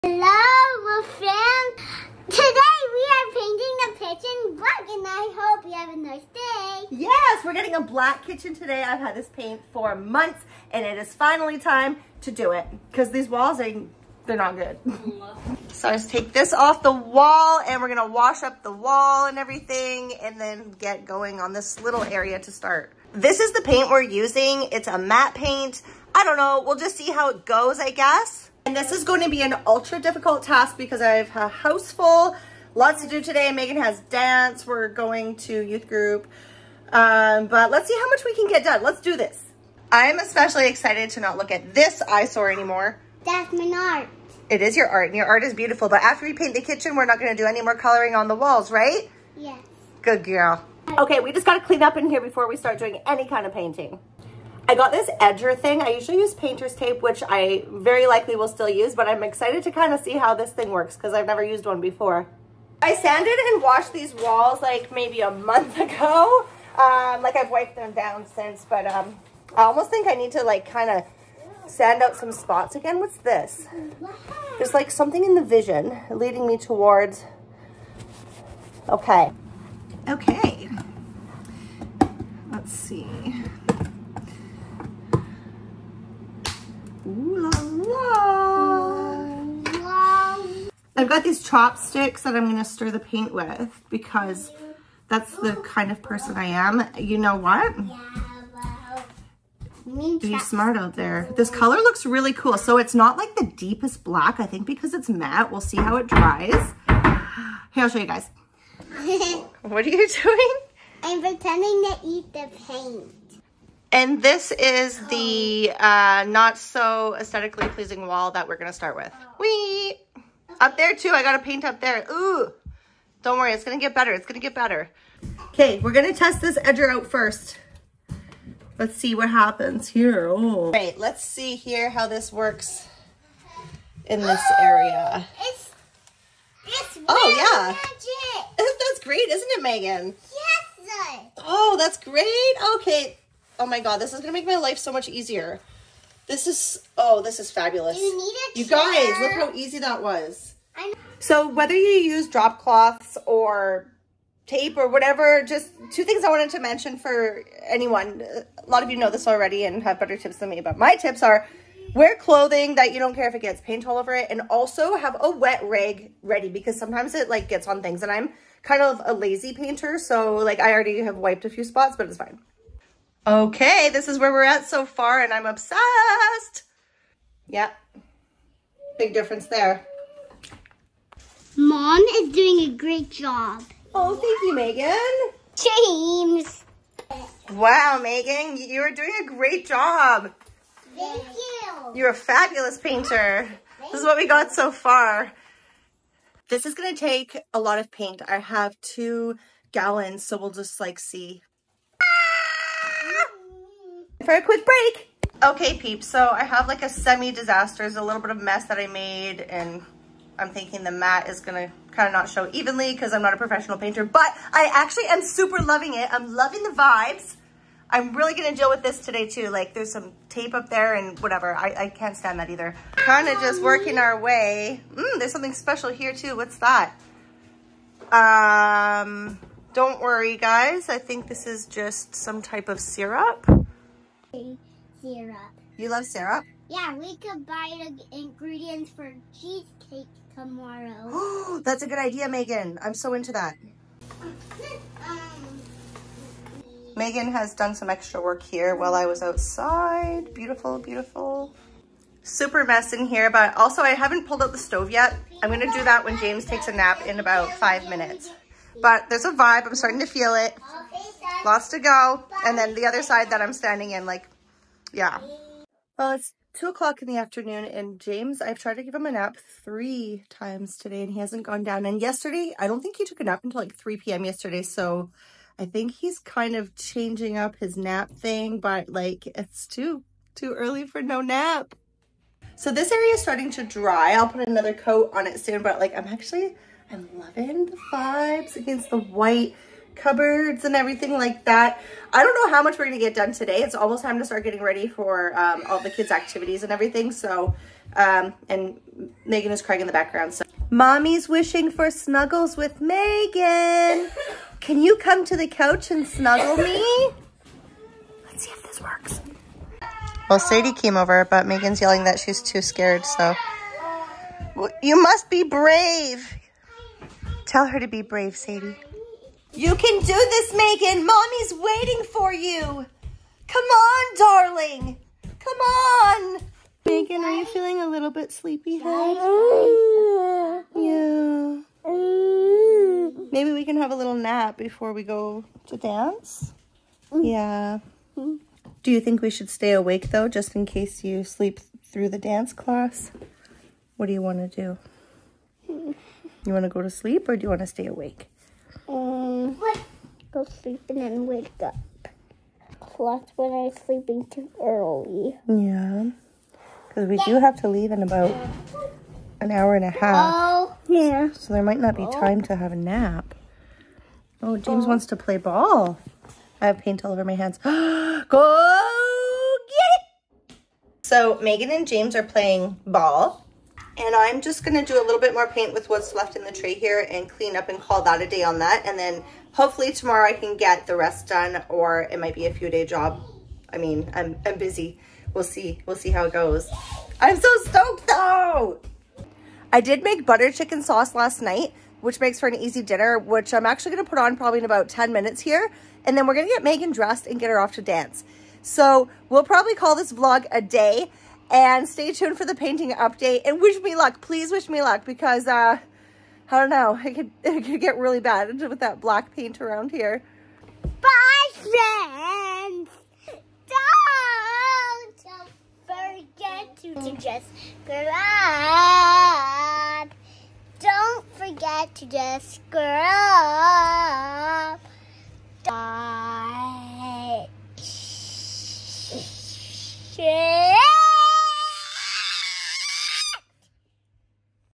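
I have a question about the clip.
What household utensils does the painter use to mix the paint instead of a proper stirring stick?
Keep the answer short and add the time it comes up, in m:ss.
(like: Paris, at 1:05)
Chopsticks, at 1:31.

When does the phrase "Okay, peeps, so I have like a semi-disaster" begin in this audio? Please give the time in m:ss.
3:25.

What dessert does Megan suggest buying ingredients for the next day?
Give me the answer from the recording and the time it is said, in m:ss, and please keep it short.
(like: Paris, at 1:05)
Cheesecake, at 3:59.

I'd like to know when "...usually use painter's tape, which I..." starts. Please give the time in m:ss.
0:55.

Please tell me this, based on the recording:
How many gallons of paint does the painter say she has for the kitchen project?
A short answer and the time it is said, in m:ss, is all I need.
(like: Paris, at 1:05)
2, at 3:18.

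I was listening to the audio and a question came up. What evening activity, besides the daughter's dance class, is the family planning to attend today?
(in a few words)
Youth group.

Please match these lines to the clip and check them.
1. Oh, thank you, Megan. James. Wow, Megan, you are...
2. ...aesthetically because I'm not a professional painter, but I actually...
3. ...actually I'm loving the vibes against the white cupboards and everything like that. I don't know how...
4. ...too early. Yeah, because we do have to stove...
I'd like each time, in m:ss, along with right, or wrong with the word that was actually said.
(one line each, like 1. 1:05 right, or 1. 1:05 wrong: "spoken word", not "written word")
1. 3:03 right
2. 3:32 wrong: "evenly", not "aesthetically"
3. 4:46 right
4. 5:54 wrong: "leave", not "stove".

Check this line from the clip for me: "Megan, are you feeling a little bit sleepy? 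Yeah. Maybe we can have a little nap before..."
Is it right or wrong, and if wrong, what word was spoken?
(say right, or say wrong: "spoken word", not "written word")
right.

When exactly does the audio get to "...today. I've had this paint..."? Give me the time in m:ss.
0:08.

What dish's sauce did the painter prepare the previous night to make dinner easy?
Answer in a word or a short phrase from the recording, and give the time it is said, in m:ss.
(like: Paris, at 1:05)
Butter chicken, at 6:30.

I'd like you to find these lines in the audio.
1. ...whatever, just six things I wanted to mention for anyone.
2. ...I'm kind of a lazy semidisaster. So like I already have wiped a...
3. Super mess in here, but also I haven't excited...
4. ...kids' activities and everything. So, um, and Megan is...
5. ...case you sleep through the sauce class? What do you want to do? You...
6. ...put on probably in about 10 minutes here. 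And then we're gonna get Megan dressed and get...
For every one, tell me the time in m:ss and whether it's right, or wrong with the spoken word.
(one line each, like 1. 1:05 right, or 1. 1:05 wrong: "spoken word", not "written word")
1. 2:34 wrong: "two", not "six"
2. 2:48 wrong: "painter", not "semidisaster"
3. 4:12 wrong: "pulled", not "excited"
4. 4:55 right
5. 5:40 wrong: "dance", not "sauce"
6. 6:34 right.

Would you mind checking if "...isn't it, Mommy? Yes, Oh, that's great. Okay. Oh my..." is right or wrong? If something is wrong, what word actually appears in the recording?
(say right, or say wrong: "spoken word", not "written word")
wrong: "Megan", not "Mommy".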